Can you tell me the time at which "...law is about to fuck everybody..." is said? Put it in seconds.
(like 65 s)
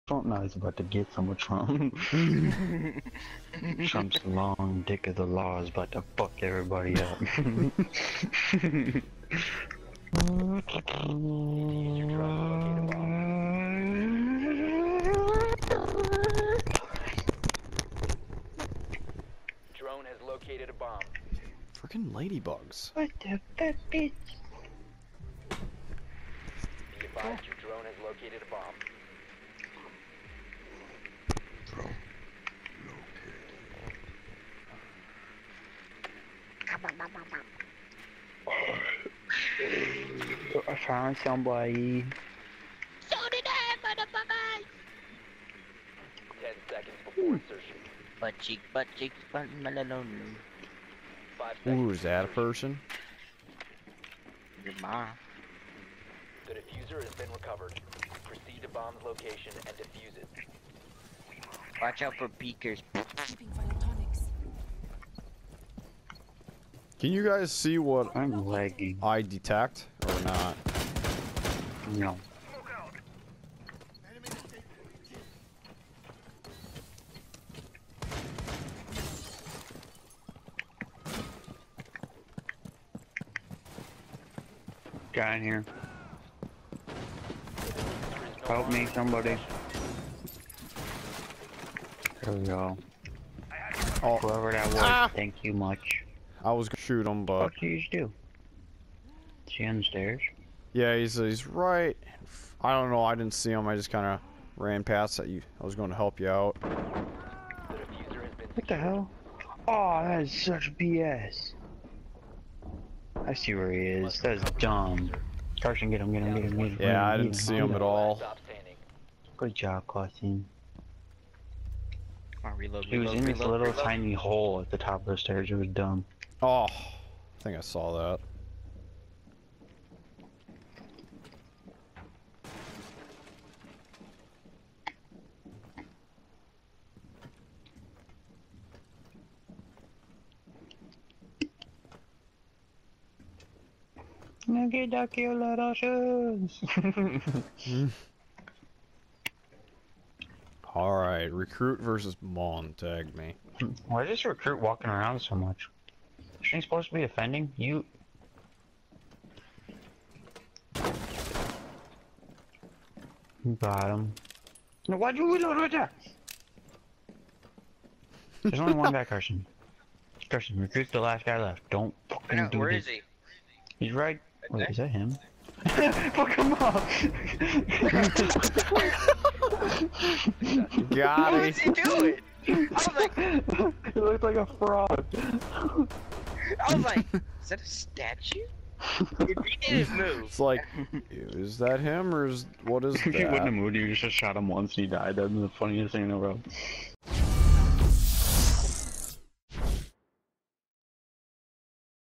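5 s.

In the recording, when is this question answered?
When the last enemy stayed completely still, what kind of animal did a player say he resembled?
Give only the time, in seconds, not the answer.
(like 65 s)
184 s.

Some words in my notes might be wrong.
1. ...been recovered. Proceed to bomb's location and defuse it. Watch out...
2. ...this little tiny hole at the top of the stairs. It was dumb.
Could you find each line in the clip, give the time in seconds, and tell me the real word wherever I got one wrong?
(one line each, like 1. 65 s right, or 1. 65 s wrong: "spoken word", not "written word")
1. 57 s right
2. 123 s right.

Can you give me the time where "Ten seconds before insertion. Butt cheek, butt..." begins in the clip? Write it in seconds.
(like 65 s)
46 s.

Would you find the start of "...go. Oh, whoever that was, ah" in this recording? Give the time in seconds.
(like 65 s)
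92 s.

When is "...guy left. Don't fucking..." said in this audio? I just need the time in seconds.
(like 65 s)
171 s.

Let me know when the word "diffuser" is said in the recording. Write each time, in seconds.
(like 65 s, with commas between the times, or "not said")
56 s.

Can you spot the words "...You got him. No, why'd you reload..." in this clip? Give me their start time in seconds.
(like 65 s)
163 s.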